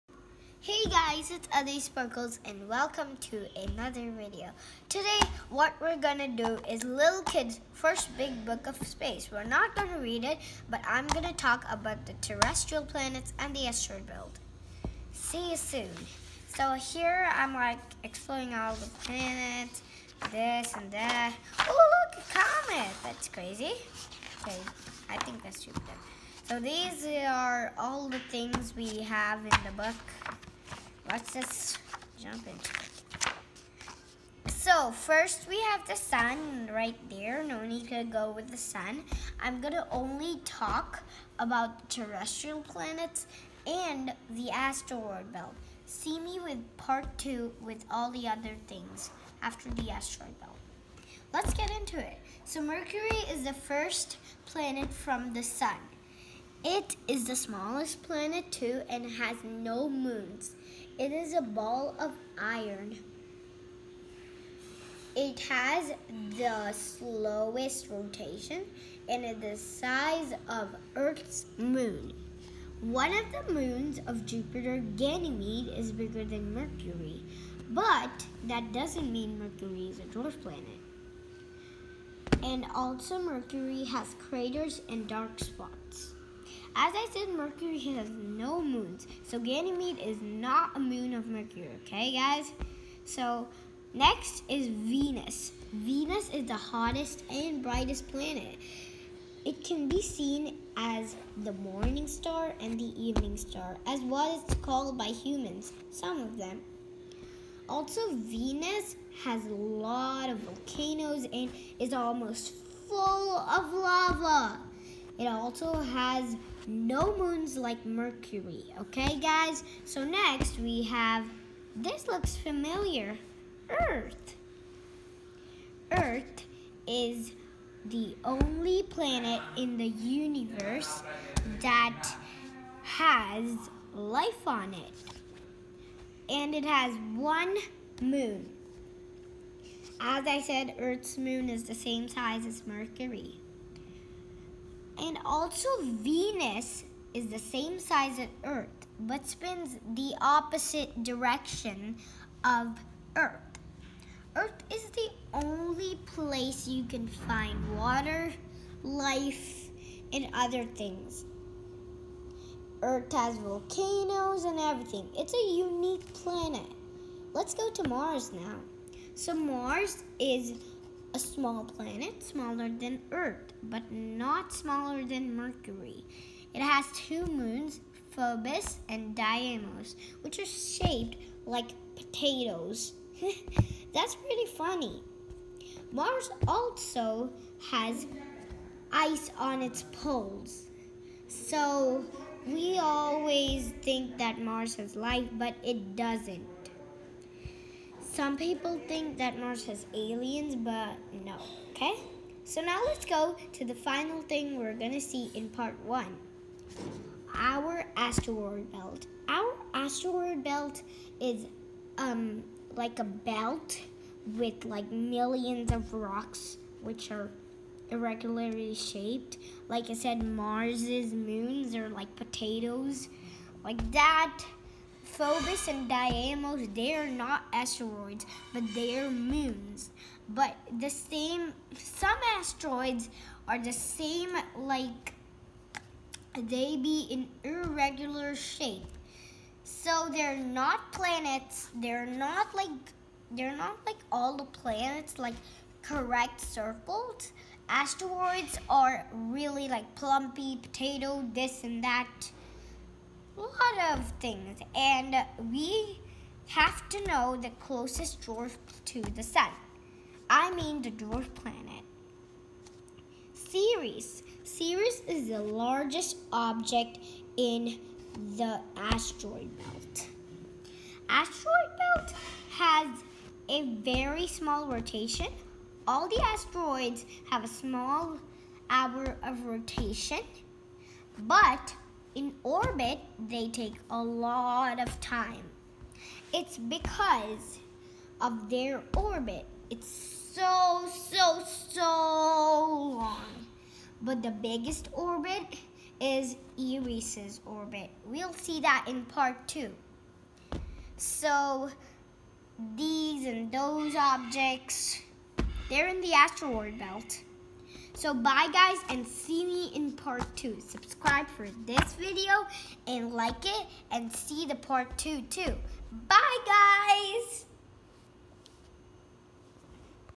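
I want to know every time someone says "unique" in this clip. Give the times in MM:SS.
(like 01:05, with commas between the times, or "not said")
02:45.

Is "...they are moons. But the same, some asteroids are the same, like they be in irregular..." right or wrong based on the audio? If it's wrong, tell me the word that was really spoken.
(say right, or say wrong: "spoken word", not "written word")
right.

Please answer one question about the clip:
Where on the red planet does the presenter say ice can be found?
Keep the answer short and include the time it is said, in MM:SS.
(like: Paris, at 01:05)
Its poles, at 03:09.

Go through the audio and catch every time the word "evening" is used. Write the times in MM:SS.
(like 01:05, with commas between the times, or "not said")
01:43.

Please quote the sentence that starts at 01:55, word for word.
It also has no moons like Mercury.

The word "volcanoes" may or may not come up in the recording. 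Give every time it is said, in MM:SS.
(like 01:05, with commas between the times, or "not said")
01:50, 02:43.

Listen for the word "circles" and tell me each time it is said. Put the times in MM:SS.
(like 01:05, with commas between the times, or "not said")
04:06.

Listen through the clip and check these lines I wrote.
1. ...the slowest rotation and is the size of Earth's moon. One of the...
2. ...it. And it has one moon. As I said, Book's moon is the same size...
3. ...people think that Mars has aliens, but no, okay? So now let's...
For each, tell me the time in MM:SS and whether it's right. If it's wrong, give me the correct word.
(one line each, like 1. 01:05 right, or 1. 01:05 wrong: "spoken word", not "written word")
1. 01:06 right
2. 02:14 wrong: "Earth", not "Book"
3. 03:18 right.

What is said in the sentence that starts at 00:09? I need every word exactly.
We're not gonna read it, but I'm gonna talk about the terrestrial planets and the asteroid belt.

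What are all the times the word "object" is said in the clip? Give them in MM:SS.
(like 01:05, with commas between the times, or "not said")
04:26, 05:03.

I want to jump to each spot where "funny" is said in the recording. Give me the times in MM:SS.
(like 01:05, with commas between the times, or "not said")
03:04.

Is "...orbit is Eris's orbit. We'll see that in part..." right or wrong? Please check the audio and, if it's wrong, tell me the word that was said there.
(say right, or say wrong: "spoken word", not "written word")
right.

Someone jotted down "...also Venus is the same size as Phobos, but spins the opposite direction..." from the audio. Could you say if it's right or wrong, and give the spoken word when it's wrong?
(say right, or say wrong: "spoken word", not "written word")
wrong: "Earth", not "Phobos".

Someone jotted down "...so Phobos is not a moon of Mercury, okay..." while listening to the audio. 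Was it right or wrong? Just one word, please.
wrong.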